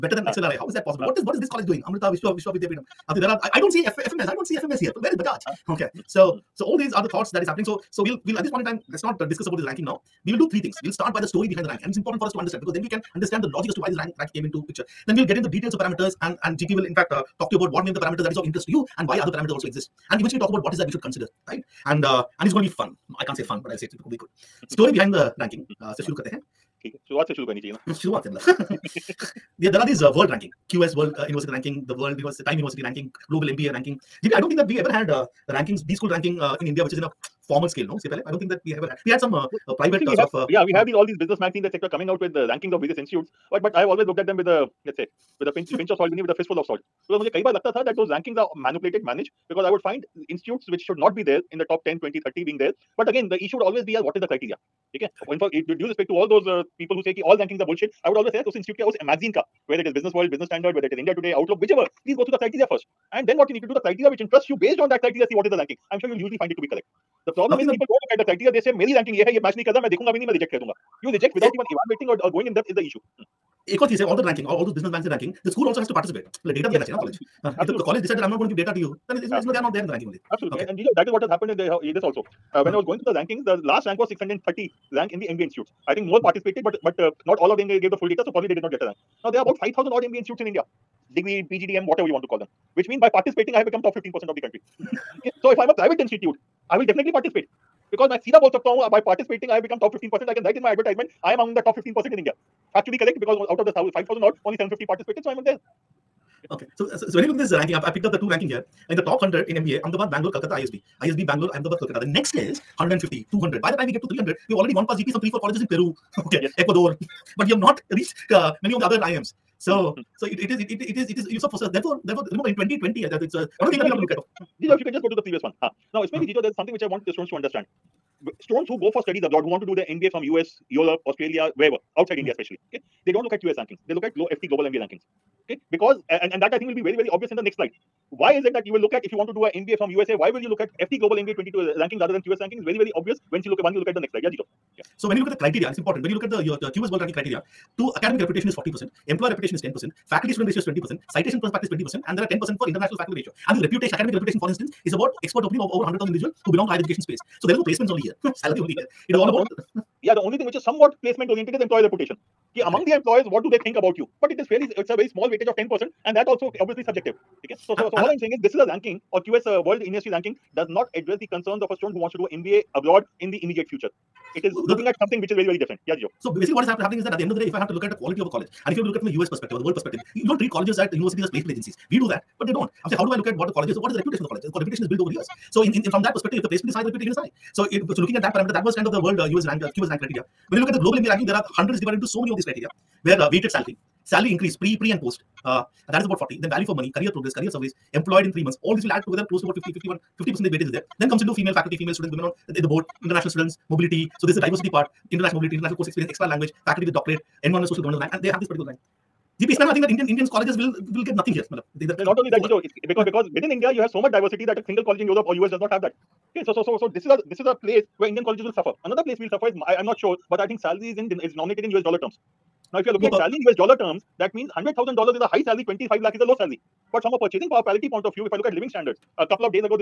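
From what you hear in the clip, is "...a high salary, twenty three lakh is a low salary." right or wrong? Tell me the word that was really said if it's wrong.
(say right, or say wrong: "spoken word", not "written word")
wrong: "five", not "three".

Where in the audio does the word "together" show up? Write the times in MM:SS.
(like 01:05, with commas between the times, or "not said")
03:19.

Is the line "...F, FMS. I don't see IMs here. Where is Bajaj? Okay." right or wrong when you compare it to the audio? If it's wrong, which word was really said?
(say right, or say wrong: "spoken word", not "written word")
wrong: "FMS", not "IMs".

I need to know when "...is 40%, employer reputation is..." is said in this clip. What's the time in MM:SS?
02:28.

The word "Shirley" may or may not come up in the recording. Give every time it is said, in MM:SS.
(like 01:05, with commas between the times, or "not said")
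not said.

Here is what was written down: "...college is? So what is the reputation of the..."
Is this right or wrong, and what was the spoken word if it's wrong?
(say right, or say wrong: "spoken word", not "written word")
right.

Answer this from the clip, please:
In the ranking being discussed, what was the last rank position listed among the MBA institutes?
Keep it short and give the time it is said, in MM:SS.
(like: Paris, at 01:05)
630, at 01:24.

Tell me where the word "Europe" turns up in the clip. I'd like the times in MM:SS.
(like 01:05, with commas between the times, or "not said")
02:10, 03:35.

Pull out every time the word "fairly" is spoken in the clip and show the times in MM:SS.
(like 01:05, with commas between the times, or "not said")
02:44.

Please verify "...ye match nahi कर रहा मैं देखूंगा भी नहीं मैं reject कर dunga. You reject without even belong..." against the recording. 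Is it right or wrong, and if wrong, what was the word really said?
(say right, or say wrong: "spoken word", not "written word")
wrong: "evaluating", not "belong".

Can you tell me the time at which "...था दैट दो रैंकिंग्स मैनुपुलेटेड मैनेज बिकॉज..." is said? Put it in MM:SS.
00:47.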